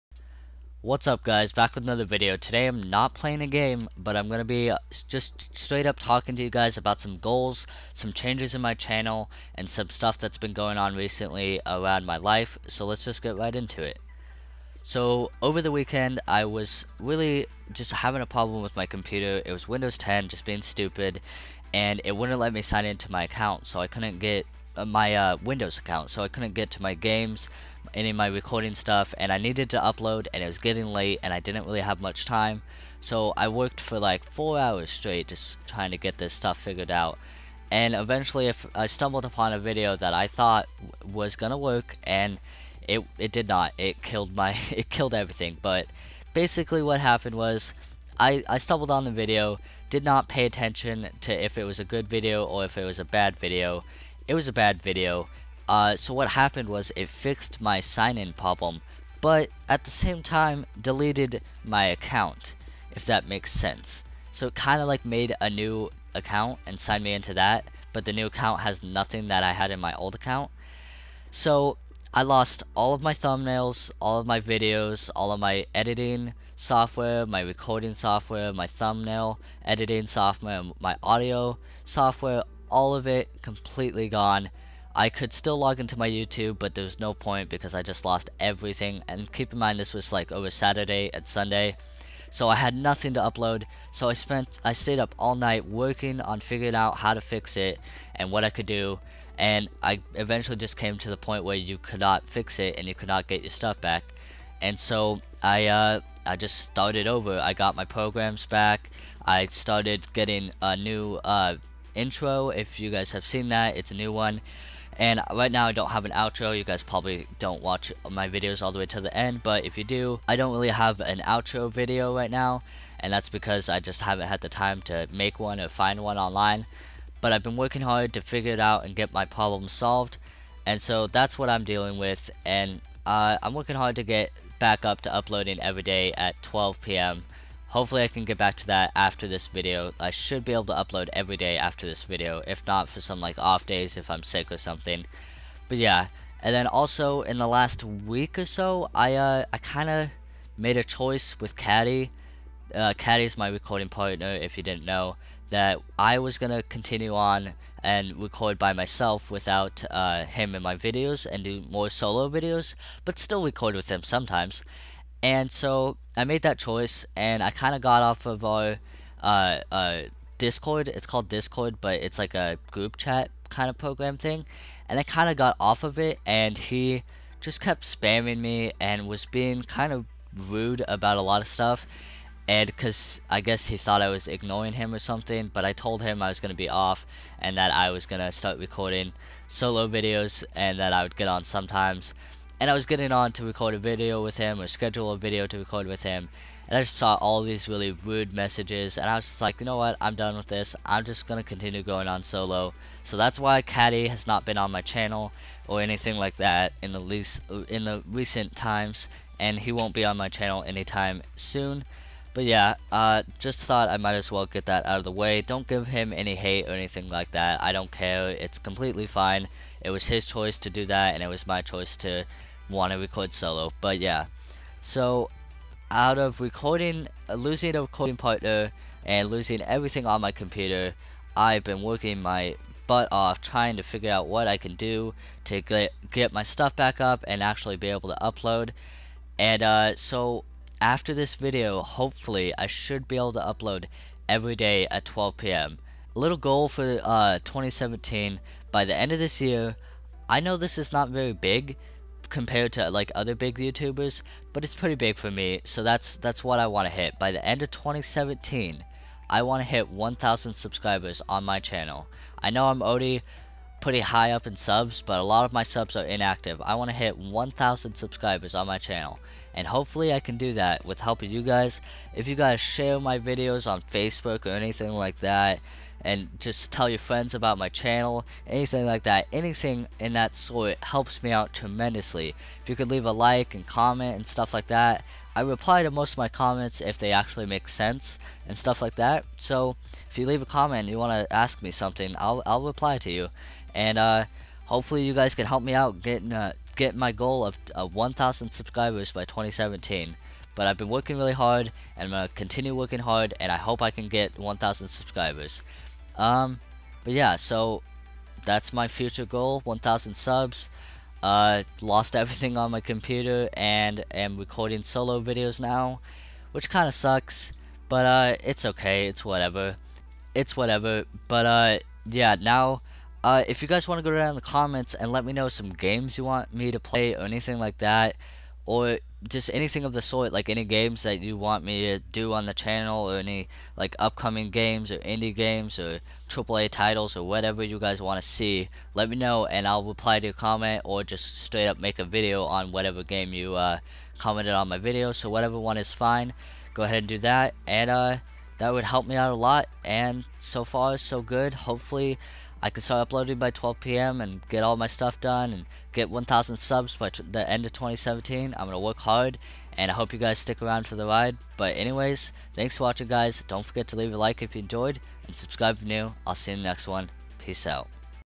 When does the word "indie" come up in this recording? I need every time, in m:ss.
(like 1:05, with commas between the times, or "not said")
5:34.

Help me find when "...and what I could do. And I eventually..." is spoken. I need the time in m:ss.
1:38.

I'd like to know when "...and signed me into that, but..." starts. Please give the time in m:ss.
1:06.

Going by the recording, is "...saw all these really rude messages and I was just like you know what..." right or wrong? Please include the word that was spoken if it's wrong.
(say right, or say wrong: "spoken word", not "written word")
right.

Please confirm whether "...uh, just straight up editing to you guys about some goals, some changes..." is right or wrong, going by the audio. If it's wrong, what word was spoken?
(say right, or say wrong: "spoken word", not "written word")
wrong: "talking", not "editing".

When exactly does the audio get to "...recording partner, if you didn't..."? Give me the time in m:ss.
2:33.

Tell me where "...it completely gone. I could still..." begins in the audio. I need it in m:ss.
1:23.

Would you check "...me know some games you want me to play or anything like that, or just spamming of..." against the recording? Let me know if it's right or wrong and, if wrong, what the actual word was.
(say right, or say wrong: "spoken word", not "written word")
wrong: "anything", not "spamming".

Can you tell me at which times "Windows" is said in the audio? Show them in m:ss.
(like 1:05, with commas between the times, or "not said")
0:19, 0:25.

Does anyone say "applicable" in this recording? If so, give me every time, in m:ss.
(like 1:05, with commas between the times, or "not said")
not said.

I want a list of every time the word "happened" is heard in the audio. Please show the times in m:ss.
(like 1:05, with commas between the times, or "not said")
0:46, 0:56.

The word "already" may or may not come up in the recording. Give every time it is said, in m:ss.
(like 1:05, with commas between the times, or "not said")
4:22.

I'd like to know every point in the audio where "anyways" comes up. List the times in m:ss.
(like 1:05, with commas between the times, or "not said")
6:01.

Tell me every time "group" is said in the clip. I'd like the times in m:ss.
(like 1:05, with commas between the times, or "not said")
2:52.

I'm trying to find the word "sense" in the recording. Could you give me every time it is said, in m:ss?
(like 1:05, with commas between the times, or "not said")
1:03, 4:47.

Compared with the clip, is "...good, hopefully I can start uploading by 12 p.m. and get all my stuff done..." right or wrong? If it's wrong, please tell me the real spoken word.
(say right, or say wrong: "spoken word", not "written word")
right.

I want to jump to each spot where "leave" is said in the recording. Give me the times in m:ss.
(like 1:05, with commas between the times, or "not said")
4:42, 4:50, 6:03.